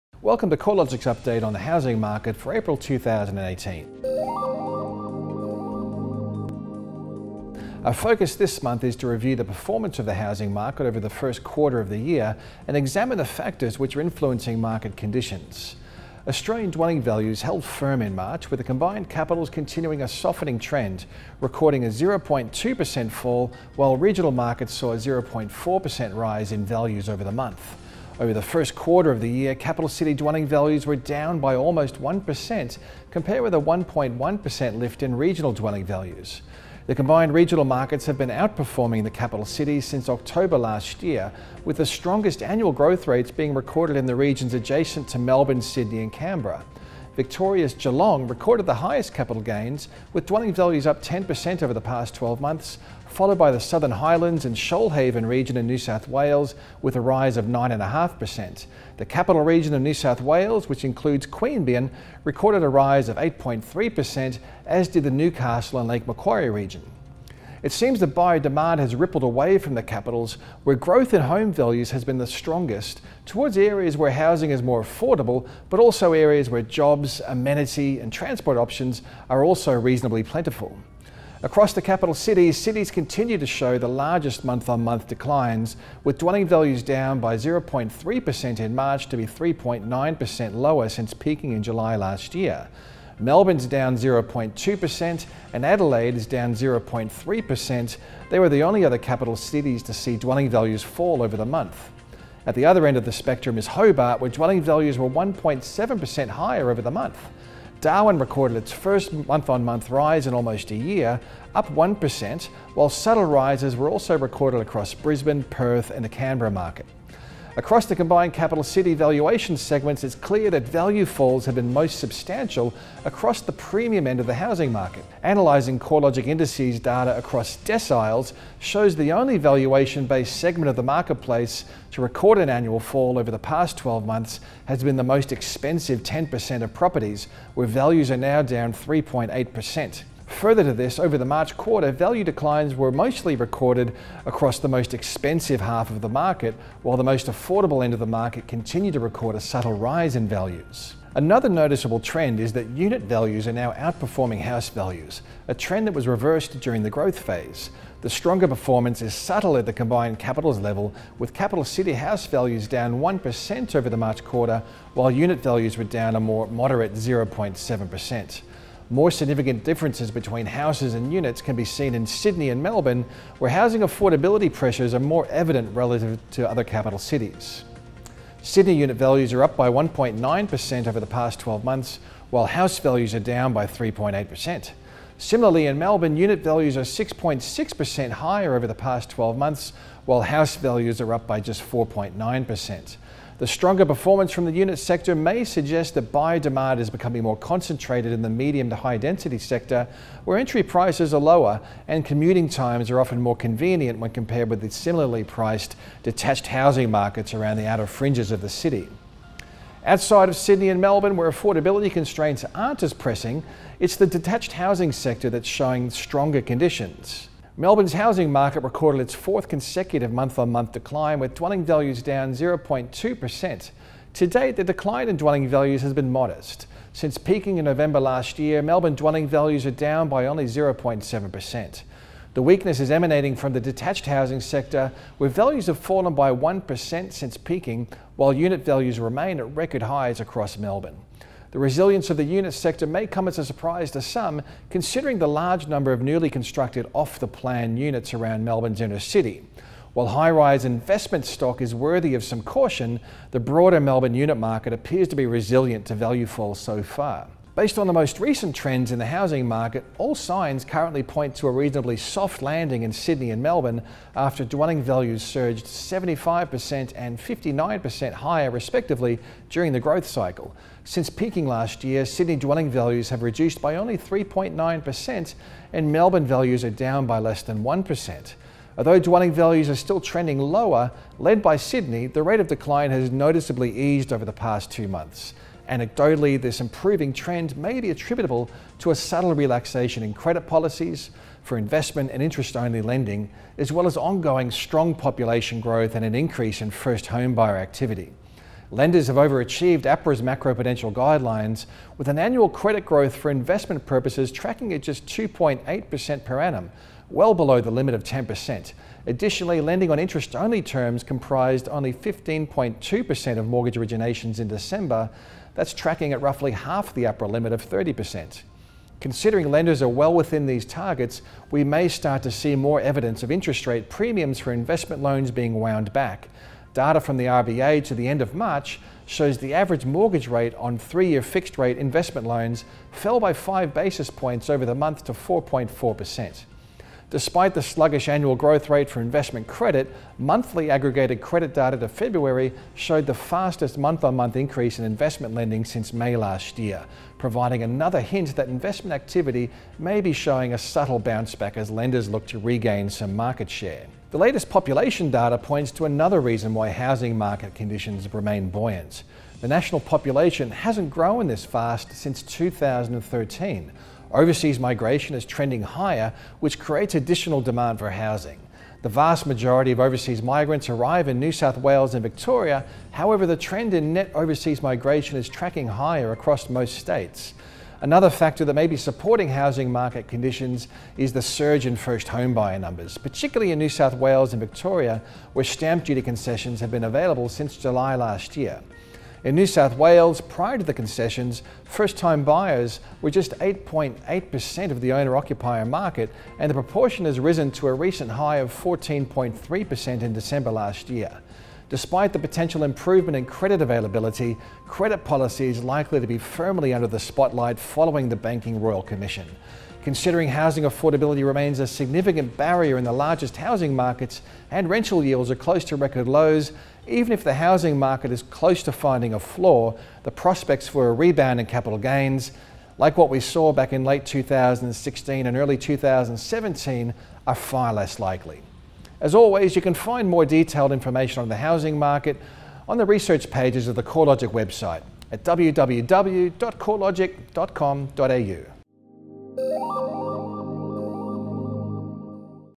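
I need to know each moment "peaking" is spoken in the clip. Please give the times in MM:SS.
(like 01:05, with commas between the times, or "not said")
01:31, 03:47, 03:57, 04:31.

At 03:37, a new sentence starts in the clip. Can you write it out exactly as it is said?
Melbourne's housing market recorded its fourth consecutive month on month decline, with dwelling values down 0.2%.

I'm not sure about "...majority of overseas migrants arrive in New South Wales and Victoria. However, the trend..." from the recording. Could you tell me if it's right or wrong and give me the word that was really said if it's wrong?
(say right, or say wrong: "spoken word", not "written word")
right.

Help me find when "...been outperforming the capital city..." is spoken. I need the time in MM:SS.
00:38.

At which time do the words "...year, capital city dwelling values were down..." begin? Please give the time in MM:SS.
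00:29.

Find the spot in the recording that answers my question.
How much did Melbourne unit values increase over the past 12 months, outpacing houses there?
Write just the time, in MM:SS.
03:06.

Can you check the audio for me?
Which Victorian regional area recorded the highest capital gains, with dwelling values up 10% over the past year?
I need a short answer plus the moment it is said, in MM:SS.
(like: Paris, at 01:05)
Geelong, at 00:47.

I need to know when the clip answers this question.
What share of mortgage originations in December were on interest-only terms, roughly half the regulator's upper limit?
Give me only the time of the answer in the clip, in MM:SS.
05:11.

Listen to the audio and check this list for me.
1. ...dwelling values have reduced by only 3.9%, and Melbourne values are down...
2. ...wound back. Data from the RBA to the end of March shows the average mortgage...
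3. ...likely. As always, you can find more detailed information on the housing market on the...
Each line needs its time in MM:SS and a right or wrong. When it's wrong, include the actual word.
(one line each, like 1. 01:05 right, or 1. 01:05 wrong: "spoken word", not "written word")
1. 04:32 right
2. 05:25 right
3. 07:07 right.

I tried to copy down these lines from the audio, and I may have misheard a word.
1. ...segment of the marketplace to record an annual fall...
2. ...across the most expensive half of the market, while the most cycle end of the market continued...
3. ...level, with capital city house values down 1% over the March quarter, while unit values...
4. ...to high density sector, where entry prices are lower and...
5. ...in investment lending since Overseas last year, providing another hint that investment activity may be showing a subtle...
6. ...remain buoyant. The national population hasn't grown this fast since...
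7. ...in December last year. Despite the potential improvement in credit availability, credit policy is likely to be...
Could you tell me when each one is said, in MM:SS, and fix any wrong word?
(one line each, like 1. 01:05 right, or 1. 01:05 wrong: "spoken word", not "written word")
1. 02:10 right
2. 02:24 wrong: "affordable", not "cycle"
3. 02:40 right
4. 03:18 right
5. 05:44 wrong: "May", not "Overseas"
6. 05:58 right
7. 06:40 right.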